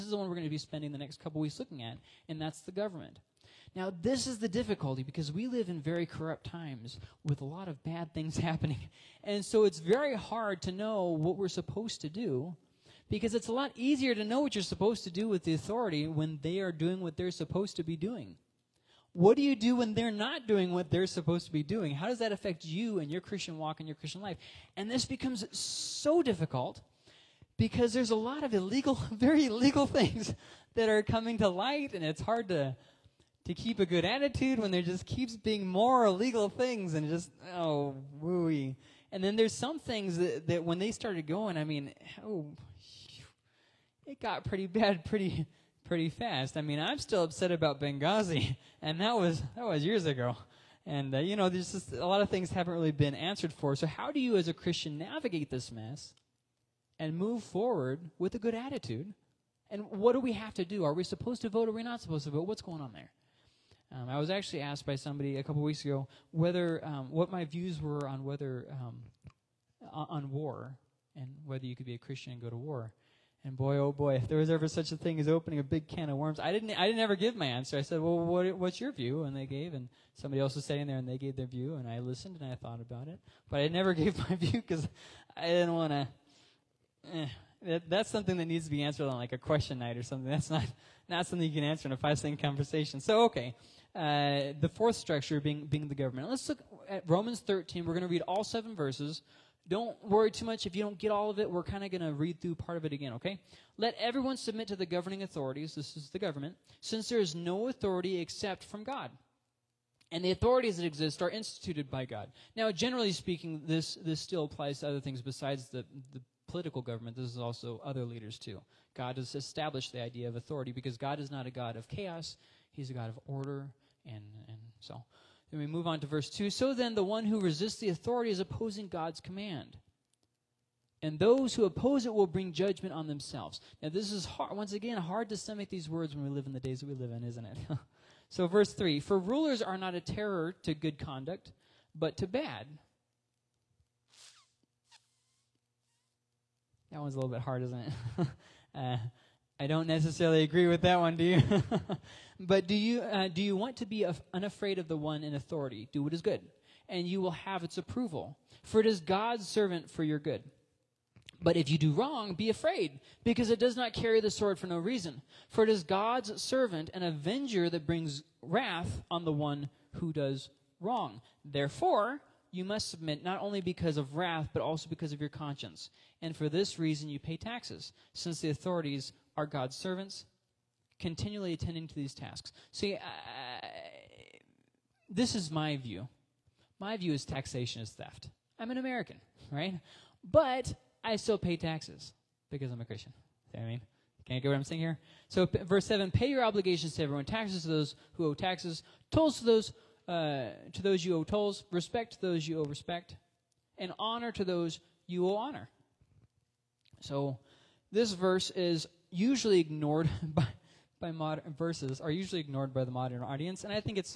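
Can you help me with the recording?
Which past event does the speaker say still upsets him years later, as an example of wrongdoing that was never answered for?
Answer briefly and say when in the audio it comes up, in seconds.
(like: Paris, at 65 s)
Benghazi, at 47 s.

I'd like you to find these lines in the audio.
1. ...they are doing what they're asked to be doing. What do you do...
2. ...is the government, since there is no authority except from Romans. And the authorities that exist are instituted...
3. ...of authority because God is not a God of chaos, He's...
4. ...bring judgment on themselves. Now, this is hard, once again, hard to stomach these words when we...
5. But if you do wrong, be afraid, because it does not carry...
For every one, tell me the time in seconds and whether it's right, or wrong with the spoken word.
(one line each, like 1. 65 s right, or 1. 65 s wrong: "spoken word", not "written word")
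1. 16 s wrong: "supposed", not "asked"
2. 105 s wrong: "God", not "Romans"
3. 120 s right
4. 132 s right
5. 161 s right.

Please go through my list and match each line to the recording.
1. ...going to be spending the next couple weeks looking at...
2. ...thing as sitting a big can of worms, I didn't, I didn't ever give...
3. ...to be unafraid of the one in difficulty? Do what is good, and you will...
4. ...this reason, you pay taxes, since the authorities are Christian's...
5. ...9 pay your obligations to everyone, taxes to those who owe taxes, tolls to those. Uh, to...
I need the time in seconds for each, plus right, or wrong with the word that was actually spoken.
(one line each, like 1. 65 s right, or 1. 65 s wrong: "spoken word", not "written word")
1. 0 s right
2. 74 s wrong: "opening", not "sitting"
3. 153 s wrong: "authority", not "difficulty"
4. 176 s wrong: "God", not "Christian"
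5. 195 s wrong: "7", not "9".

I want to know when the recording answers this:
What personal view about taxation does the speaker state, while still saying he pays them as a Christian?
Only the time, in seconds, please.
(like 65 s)
187 s.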